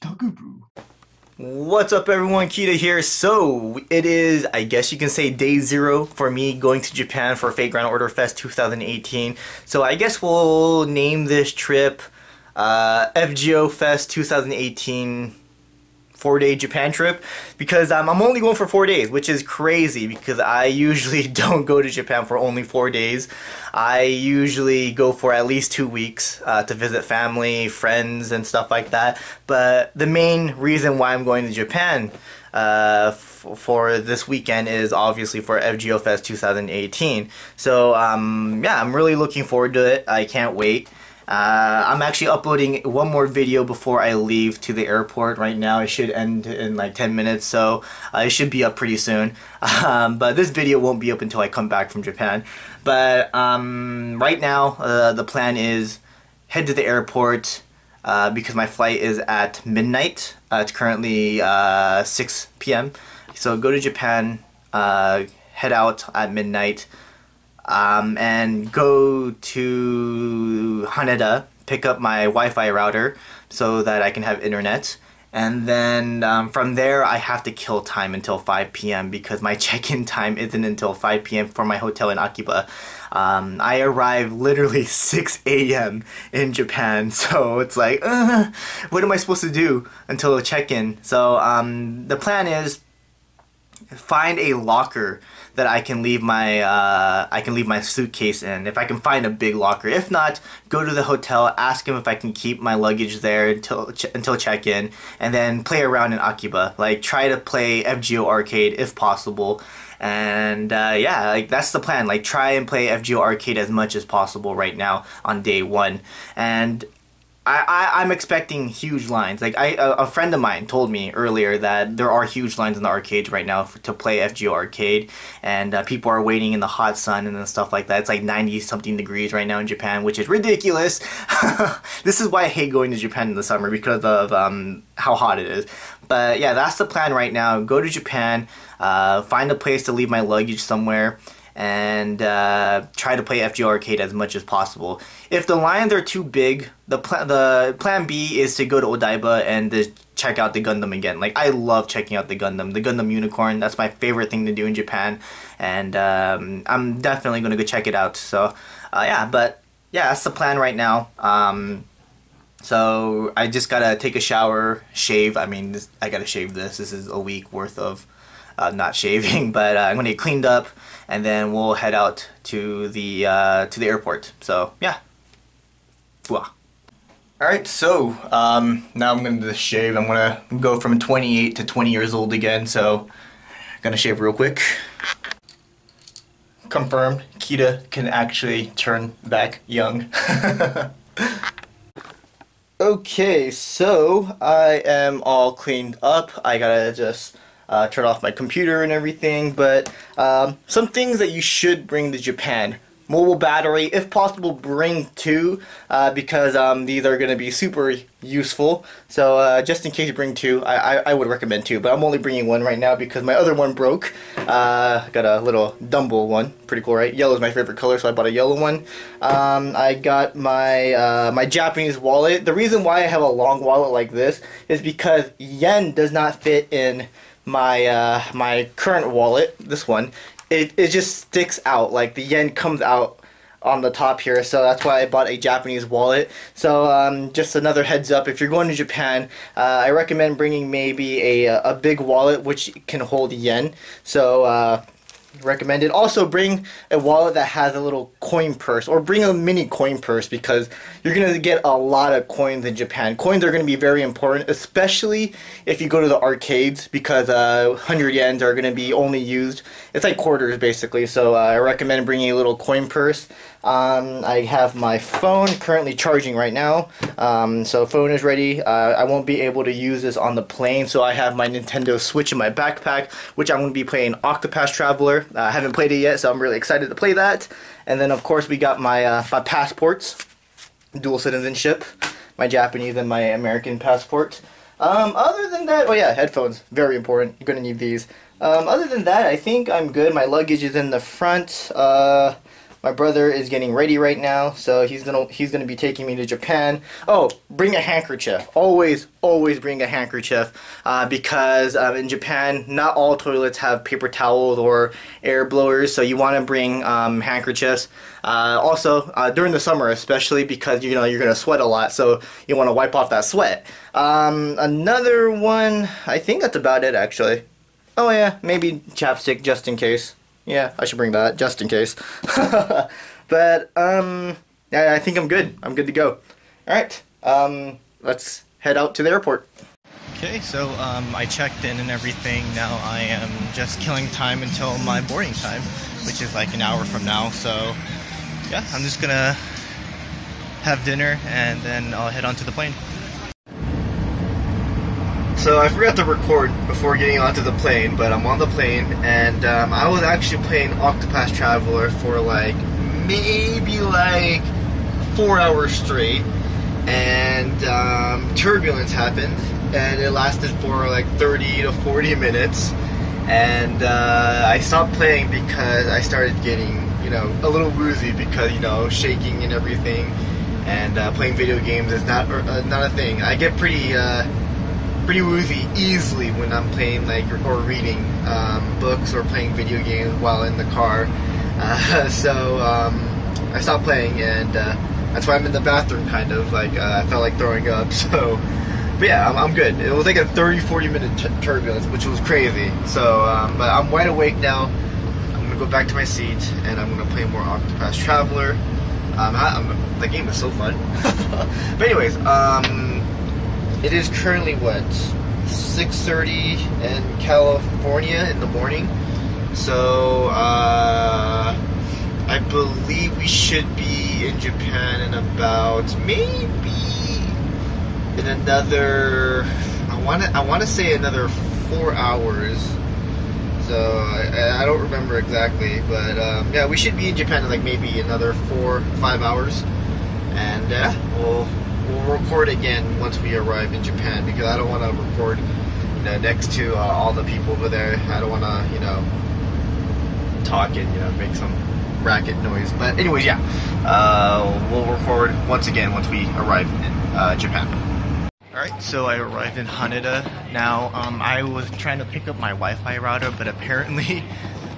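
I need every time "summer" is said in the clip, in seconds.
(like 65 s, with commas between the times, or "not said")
133 s, 309 s.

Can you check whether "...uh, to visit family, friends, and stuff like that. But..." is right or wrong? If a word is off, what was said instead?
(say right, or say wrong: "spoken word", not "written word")
right.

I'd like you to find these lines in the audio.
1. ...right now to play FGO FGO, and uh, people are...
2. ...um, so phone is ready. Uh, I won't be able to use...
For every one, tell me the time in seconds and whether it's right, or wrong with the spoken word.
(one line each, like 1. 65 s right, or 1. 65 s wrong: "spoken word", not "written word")
1. 123 s wrong: "Arcade", not "FGO"
2. 267 s right.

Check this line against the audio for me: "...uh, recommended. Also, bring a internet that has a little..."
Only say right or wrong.
wrong.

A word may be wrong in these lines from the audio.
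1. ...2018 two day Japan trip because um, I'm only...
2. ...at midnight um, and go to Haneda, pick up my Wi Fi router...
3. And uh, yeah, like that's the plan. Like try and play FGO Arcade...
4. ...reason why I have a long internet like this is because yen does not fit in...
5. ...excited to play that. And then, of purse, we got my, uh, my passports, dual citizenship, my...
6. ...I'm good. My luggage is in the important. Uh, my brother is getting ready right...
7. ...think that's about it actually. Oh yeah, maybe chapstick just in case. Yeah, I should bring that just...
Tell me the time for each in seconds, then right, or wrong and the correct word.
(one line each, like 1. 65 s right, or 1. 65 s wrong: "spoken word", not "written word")
1. 14 s wrong: "four", not "two"
2. 66 s right
3. 110 s right
4. 222 s wrong: "wallet", not "internet"
5. 276 s wrong: "course", not "purse"
6. 289 s wrong: "front", not "important"
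7. 316 s right.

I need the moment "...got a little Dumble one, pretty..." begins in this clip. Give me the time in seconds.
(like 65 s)
215 s.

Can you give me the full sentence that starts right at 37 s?
So um, yeah, I'm really looking forward to it.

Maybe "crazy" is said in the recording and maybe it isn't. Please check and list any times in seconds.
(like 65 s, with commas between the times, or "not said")
19 s, 392 s.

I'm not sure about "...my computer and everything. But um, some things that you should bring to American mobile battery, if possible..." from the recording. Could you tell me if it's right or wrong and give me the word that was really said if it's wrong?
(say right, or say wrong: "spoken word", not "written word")
wrong: "Japan", not "American".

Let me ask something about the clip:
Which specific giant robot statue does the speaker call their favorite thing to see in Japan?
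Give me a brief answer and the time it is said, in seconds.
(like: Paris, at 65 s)
Gundam Unicorn, at 152 s.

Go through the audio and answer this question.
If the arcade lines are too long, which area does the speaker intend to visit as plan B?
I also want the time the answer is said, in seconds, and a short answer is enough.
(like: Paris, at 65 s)
Odaiba, at 148 s.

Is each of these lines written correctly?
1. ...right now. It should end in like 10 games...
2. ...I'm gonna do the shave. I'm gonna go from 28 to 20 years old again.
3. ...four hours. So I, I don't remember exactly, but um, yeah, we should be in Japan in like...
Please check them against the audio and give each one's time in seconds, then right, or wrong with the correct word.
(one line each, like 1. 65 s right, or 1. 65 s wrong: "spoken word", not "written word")
1. 45 s wrong: "minutes", not "games"
2. 179 s right
3. 421 s right.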